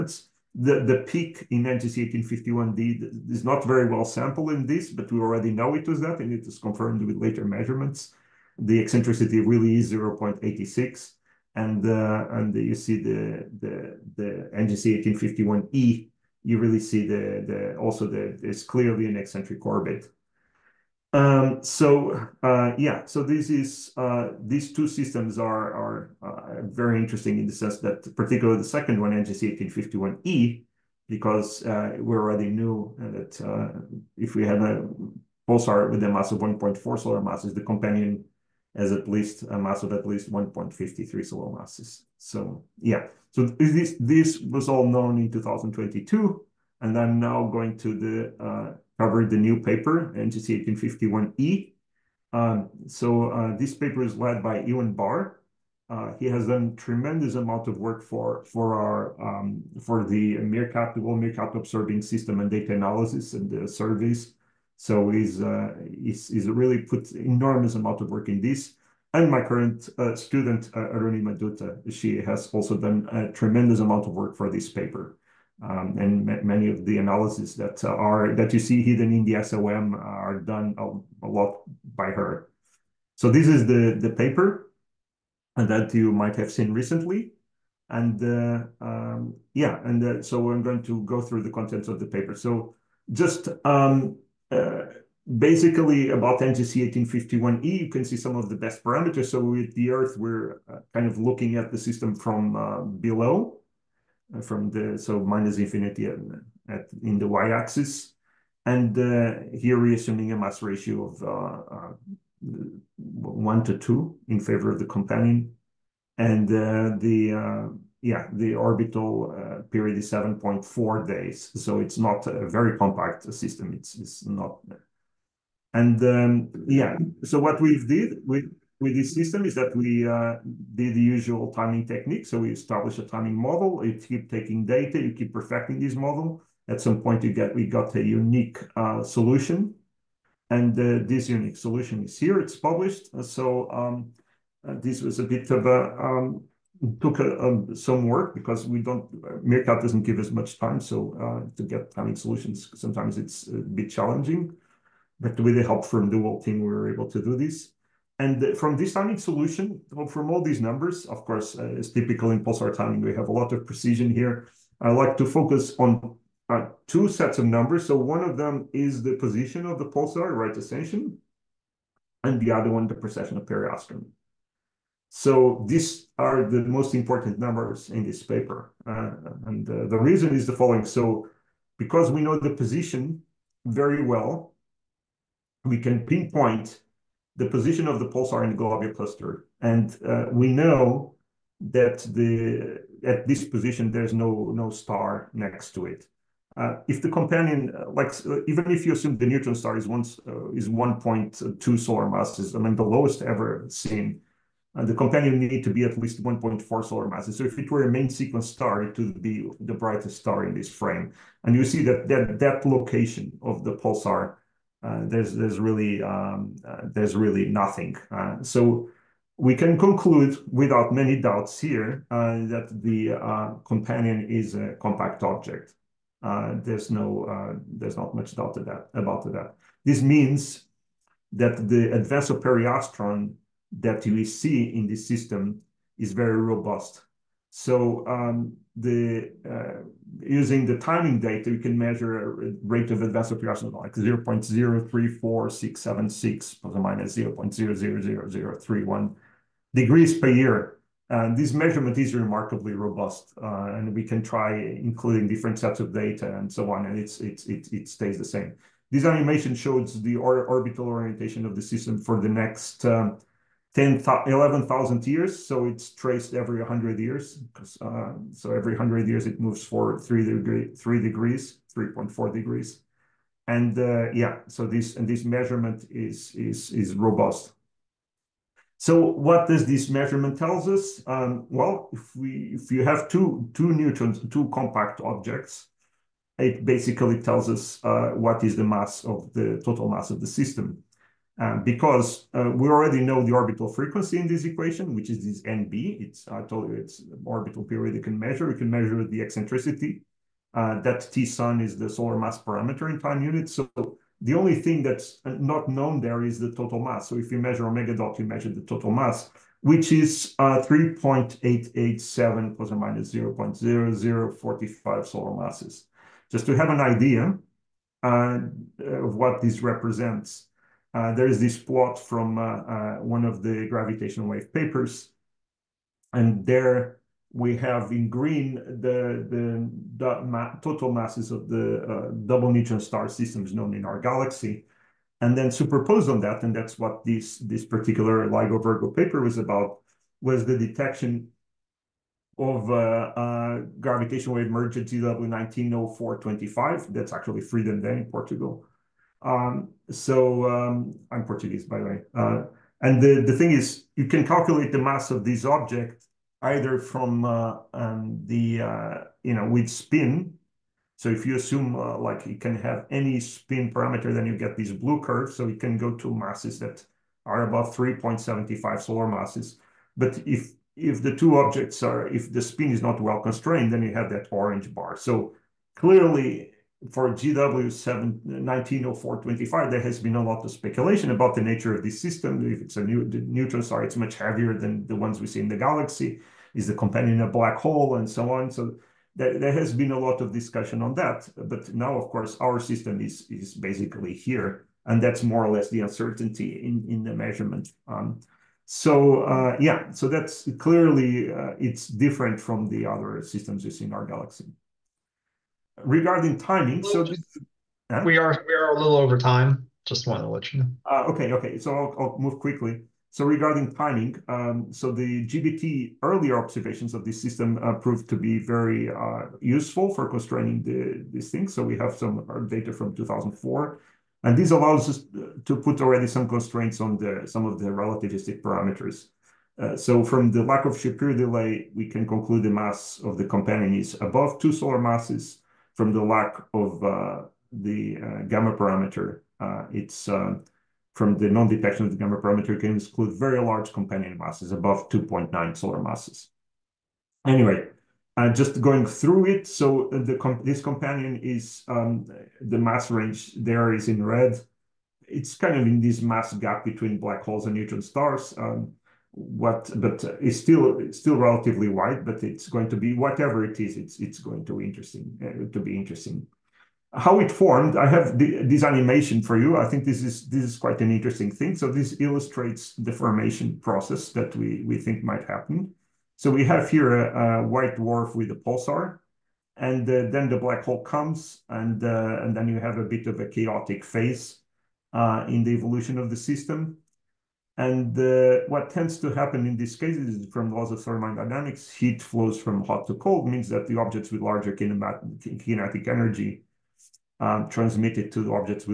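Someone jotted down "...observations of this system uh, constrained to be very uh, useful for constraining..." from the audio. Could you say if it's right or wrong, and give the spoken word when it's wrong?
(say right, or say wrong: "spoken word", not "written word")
wrong: "proved", not "constrained".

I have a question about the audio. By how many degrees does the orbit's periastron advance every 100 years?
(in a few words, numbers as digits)
3.4 degrees.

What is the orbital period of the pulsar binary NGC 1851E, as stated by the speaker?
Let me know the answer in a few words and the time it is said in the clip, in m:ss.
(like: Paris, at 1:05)
7.4 days, at 2:00.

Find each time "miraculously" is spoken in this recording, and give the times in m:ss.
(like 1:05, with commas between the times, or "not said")
not said.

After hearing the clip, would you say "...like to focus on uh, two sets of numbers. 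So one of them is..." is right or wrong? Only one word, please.
right.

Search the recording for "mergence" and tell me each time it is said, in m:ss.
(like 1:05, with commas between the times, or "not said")
5:44.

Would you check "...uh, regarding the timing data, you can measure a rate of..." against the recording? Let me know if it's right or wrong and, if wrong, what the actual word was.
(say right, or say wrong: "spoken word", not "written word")
wrong: "using", not "regarding".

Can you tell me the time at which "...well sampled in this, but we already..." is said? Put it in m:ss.
0:03.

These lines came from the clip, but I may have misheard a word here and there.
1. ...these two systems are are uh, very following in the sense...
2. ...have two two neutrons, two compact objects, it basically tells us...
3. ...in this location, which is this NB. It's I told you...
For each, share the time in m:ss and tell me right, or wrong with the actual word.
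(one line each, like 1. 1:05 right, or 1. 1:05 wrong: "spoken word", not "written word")
1. 0:24 wrong: "interesting", not "following"
2. 4:42 right
3. 4:54 wrong: "equation", not "location".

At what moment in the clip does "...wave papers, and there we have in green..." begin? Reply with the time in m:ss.
5:24.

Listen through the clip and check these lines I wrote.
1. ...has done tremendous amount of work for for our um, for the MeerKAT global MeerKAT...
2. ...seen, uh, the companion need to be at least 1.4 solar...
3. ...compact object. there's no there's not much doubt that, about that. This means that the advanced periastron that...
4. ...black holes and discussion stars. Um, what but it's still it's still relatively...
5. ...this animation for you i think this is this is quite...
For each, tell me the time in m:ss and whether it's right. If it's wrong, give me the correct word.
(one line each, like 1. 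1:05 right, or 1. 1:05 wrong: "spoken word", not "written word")
1. 0:56 right
2. 3:23 right
3. 3:44 right
4. 7:36 wrong: "neutron", not "discussion"
5. 7:48 right.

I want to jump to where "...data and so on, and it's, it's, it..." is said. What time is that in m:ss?
4:15.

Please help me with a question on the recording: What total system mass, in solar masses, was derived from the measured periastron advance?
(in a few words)
3.887.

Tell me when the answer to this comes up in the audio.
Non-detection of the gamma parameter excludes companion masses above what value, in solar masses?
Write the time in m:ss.
7:24.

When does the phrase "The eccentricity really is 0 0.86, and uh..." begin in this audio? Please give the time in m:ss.
0:08.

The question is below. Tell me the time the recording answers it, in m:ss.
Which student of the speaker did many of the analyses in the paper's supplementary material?
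1:10.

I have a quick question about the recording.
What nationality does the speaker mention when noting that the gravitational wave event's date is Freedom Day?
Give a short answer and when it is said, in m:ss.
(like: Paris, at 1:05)
Portuguese, at 5:51.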